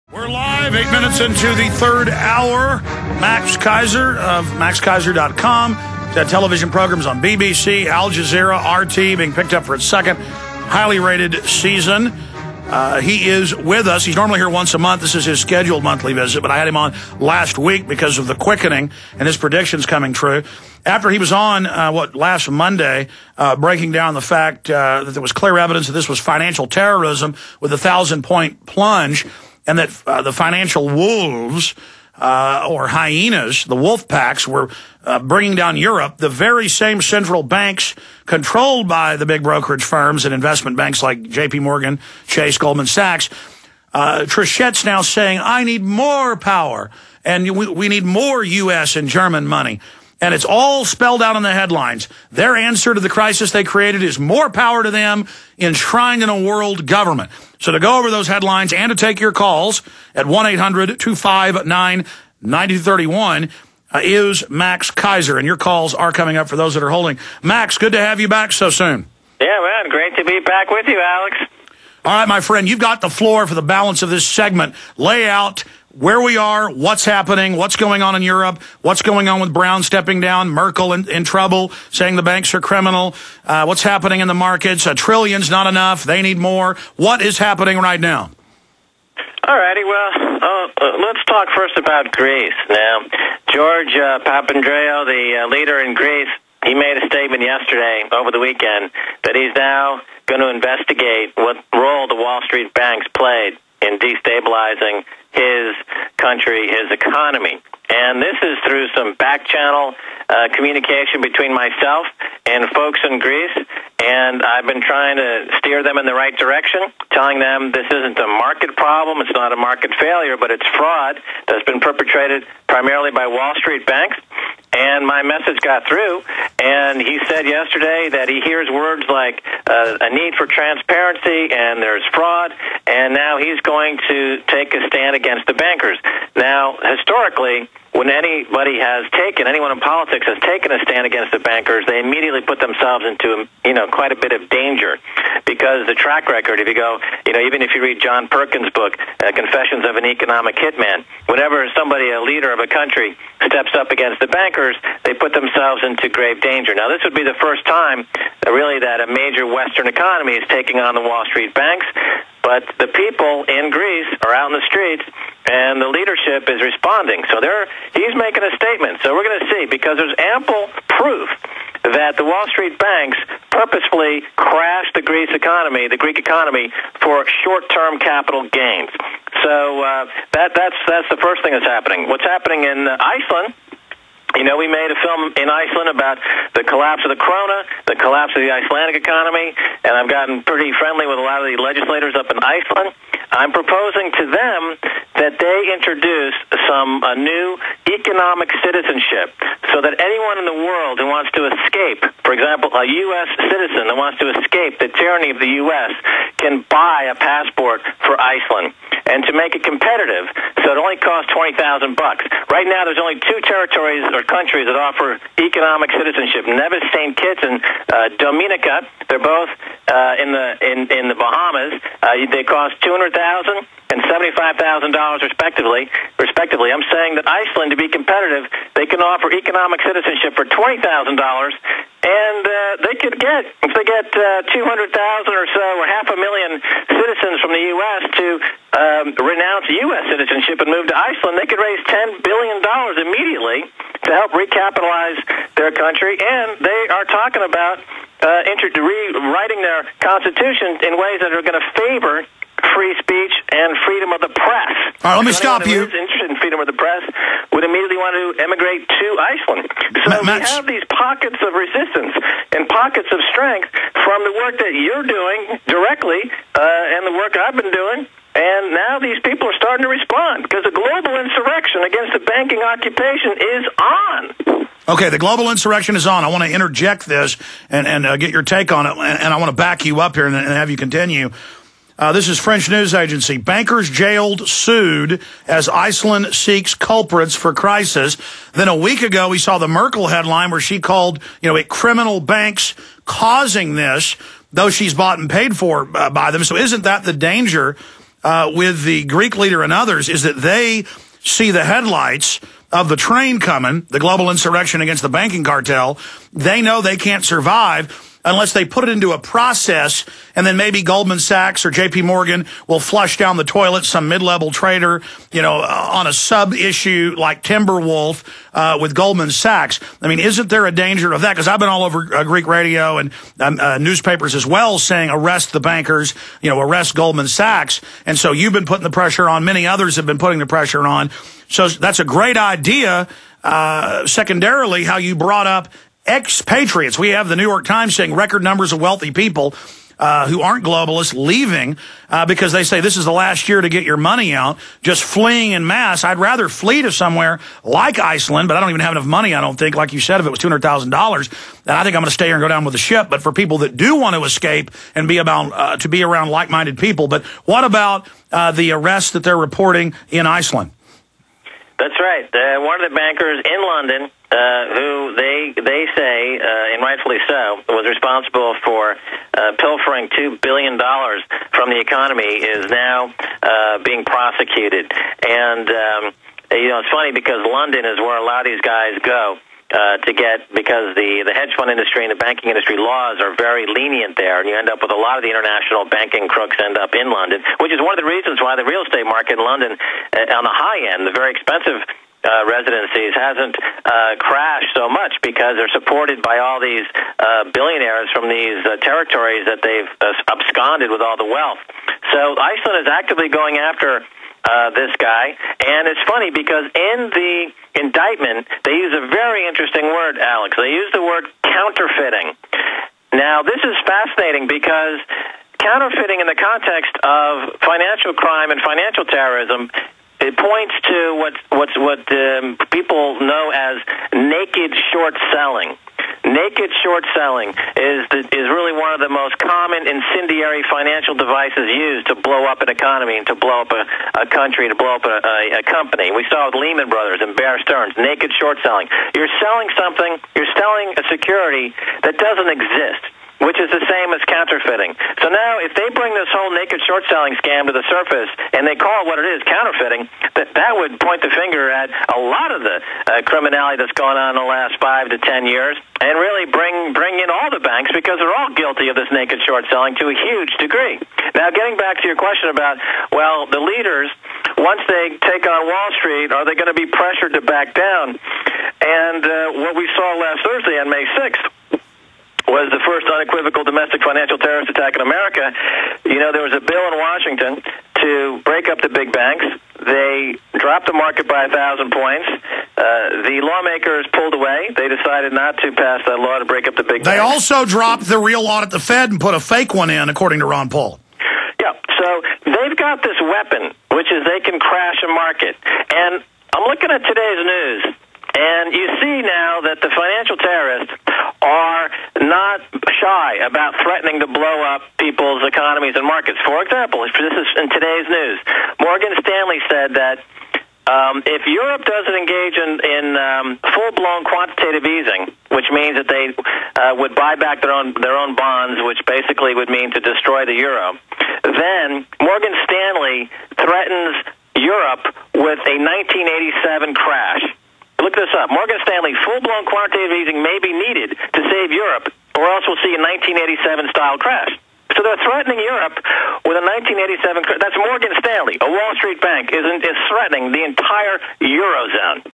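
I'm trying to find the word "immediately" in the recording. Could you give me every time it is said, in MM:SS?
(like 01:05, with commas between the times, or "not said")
02:21, 04:03.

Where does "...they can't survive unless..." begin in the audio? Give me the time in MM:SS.
05:06.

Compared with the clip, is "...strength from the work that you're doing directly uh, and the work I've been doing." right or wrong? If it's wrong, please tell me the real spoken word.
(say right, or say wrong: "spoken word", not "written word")
right.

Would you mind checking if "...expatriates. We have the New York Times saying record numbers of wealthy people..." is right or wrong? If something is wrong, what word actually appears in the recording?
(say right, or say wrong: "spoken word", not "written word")
right.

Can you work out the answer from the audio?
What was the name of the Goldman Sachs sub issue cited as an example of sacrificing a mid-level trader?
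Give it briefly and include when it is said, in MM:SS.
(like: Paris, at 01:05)
Timberwolf, at 05:17.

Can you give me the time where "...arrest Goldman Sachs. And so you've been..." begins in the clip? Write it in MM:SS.
05:26.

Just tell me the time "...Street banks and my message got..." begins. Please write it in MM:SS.
02:03.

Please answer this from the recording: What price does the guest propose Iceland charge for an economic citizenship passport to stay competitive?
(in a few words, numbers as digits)
$20,000.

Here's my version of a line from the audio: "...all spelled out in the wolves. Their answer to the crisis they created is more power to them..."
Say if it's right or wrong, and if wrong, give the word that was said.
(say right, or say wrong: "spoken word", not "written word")
wrong: "headlines", not "wolves".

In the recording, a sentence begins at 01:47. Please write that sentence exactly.
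And this is through some back channel uh, communication between myself and folks in Greece.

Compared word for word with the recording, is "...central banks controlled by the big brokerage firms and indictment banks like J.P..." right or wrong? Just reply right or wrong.
wrong.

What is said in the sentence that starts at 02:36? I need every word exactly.
Now, this would be the first time, that uh, really, that a major Western economy is taking on the Wall Street banks.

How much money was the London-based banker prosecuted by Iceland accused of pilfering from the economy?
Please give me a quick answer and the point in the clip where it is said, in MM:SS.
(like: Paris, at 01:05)
$2 billion, at 06:10.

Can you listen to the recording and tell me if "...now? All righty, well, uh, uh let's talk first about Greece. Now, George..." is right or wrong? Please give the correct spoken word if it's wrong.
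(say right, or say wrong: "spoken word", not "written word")
right.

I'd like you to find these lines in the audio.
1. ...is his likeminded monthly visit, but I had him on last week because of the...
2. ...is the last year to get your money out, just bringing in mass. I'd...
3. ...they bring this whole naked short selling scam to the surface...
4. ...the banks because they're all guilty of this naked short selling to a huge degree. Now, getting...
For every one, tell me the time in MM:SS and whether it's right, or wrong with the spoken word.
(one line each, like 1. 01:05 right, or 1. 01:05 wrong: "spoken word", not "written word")
1. 00:15 wrong: "scheduled", not "likeminded"
2. 05:42 wrong: "fleeing", not "bringing"
3. 07:25 right
4. 07:37 right.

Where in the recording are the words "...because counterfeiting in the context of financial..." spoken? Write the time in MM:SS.
06:54.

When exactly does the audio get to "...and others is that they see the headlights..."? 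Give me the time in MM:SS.
04:59.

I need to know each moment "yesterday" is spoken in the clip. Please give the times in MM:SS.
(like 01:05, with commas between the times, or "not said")
01:37, 02:07.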